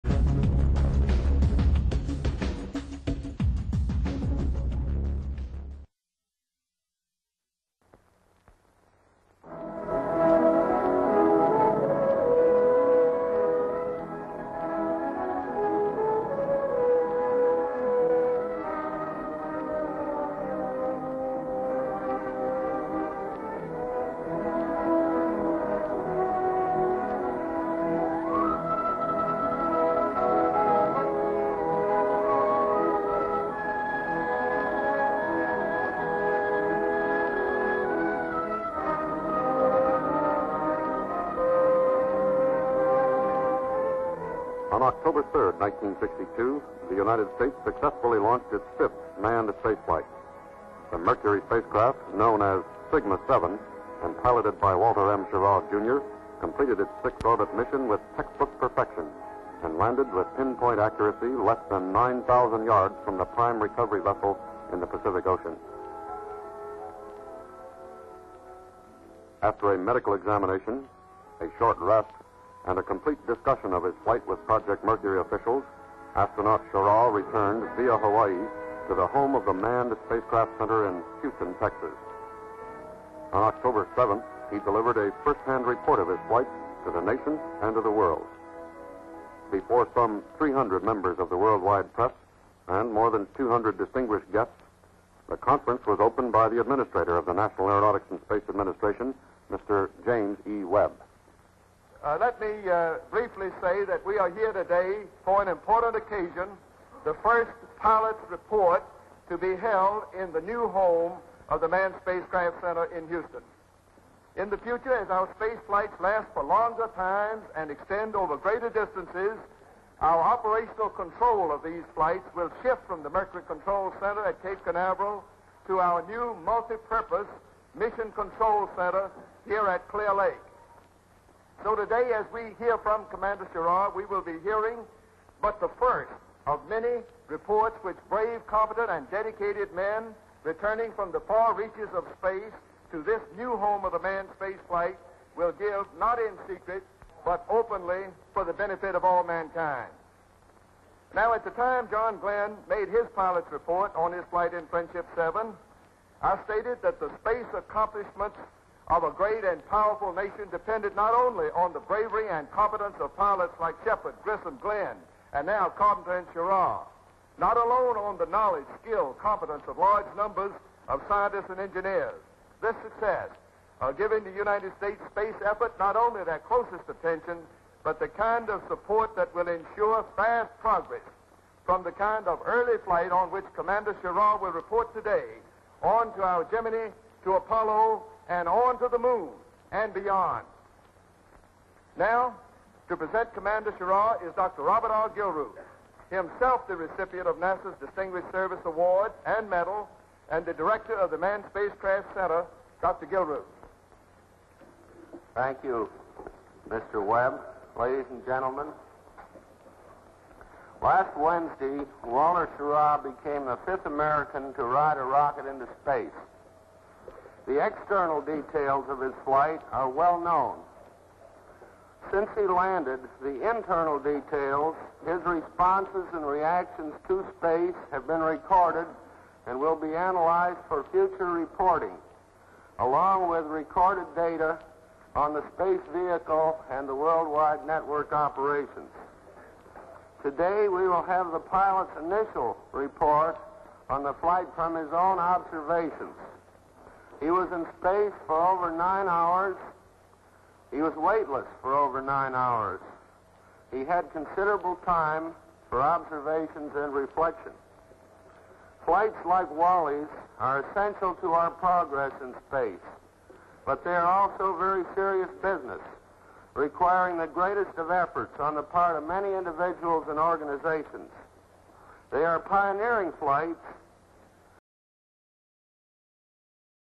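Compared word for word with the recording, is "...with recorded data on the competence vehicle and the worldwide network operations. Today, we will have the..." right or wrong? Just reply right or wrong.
wrong.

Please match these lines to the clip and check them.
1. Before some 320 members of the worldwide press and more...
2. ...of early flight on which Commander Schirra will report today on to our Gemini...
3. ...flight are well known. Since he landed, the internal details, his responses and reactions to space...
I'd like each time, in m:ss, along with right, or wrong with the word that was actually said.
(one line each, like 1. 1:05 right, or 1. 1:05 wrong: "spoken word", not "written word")
1. 1:29 wrong: "300", not "320"
2. 3:02 right
3. 3:39 right.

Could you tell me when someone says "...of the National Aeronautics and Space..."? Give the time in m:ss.
1:37.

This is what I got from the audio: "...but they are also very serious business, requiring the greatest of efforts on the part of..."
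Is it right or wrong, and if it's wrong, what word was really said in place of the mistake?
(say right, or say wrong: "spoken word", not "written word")
right.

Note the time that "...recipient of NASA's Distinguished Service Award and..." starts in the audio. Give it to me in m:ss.
3:16.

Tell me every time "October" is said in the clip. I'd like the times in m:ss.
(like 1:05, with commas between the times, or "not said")
0:44, 1:23.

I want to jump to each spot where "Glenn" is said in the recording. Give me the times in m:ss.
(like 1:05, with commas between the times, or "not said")
2:32, 2:44.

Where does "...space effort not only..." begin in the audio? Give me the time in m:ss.
2:55.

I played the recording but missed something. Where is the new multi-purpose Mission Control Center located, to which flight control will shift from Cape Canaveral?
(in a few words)
Clear Lake.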